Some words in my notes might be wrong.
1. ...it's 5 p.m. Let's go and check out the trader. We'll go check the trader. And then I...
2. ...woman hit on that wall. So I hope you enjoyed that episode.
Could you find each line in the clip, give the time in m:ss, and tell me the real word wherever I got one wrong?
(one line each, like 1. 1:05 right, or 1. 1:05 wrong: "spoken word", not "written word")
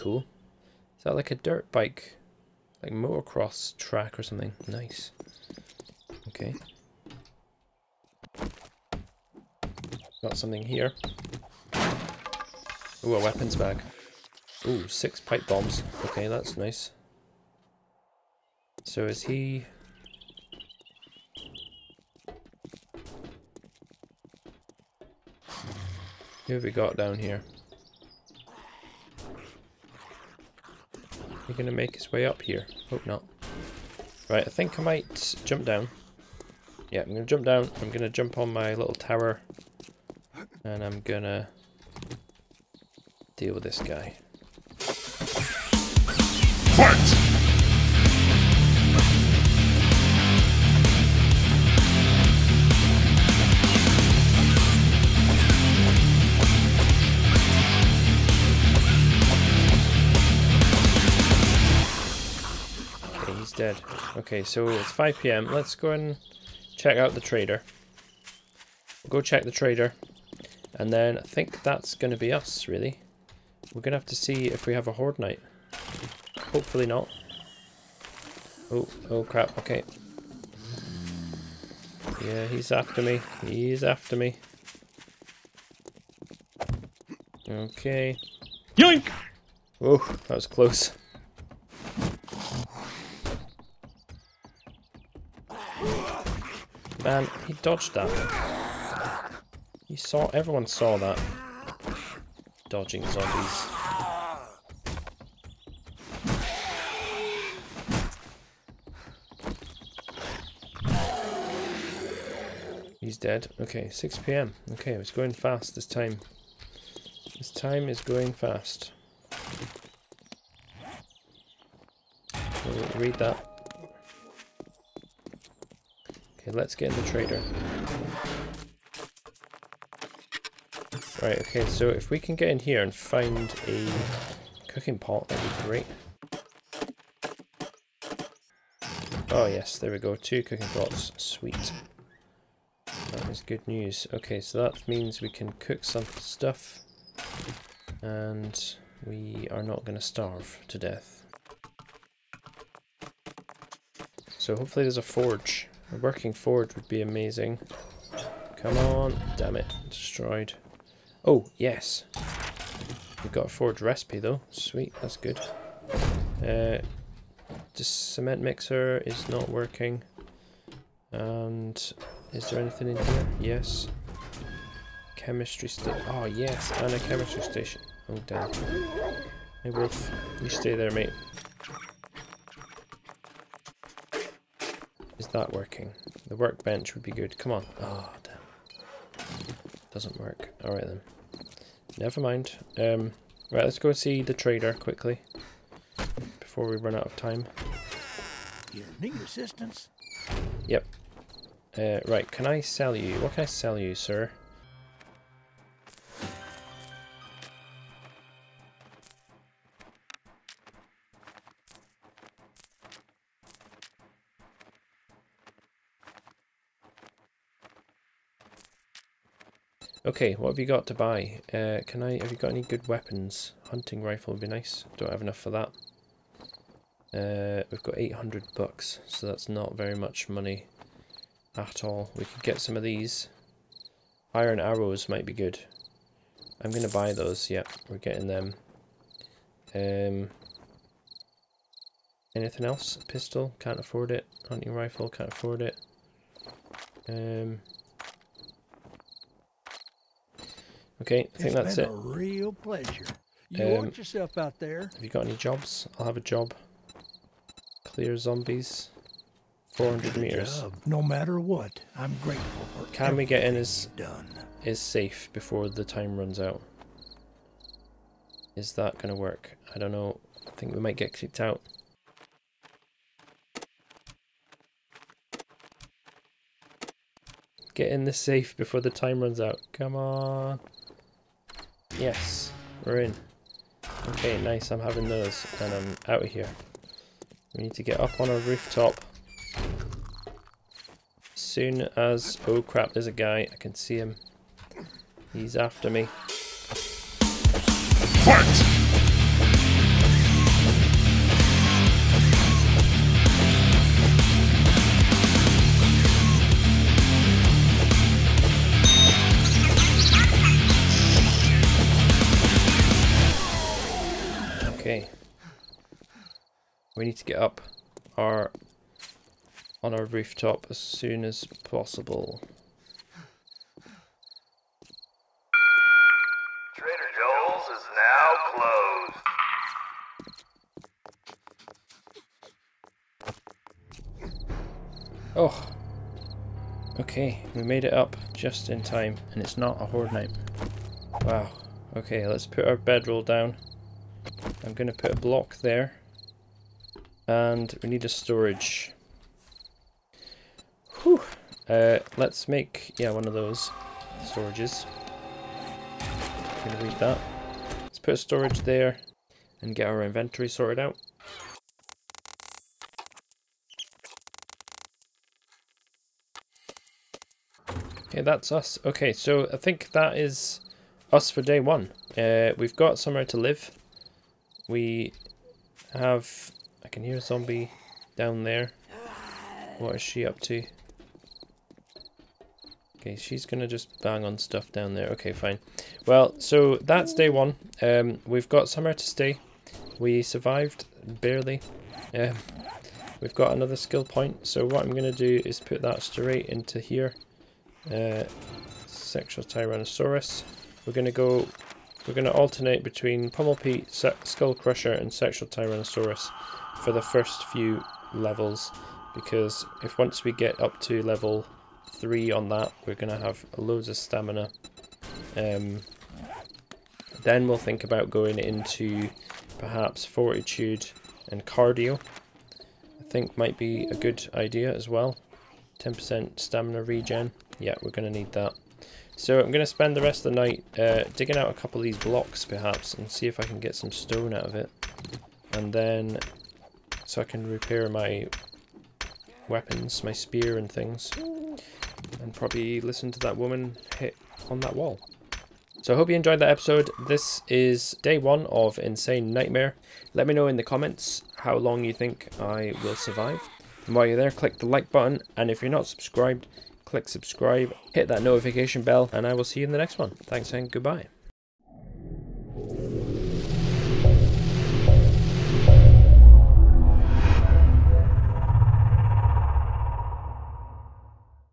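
1. 1:04 right
2. 7:23 right.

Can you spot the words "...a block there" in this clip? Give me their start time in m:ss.
5:45.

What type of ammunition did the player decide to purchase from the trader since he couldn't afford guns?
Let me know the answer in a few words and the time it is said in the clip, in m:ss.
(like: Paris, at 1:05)
iron arrows, at 3:54.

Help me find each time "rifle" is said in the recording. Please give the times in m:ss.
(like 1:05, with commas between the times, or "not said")
3:44, 4:04.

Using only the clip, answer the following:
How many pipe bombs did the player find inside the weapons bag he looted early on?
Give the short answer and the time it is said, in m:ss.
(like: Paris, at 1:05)
6, at 0:14.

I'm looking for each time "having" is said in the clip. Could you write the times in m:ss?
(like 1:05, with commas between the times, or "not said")
4:44.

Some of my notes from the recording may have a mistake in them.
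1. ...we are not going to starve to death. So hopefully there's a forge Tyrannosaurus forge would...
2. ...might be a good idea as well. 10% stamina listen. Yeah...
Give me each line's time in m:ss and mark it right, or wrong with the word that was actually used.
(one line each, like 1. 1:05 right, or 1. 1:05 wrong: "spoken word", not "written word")
1. 2:29 wrong: "Working", not "Tyrannosaurus"
2. 7:03 wrong: "regen", not "listen".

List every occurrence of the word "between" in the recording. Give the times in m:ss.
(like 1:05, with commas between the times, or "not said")
6:42.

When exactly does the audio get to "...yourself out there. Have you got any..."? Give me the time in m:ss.
4:13.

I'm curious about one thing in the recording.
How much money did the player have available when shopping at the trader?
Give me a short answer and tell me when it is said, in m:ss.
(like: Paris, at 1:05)
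800 bucks, at 3:47.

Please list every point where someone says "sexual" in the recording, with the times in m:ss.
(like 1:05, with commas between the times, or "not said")
6:38, 6:45.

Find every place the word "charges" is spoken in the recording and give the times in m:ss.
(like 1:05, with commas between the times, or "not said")
not said.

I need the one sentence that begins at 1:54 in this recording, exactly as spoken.
Okay, it's going fast this time.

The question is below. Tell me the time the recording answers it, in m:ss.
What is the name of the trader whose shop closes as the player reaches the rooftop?
5:26.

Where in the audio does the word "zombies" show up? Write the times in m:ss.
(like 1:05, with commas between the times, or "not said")
1:43, 4:18, 6:17.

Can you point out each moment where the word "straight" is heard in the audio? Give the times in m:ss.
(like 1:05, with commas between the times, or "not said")
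6:36.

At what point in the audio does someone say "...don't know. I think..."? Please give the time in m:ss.
4:29.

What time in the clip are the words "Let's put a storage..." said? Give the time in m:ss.
5:57.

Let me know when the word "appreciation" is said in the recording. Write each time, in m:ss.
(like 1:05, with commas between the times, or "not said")
not said.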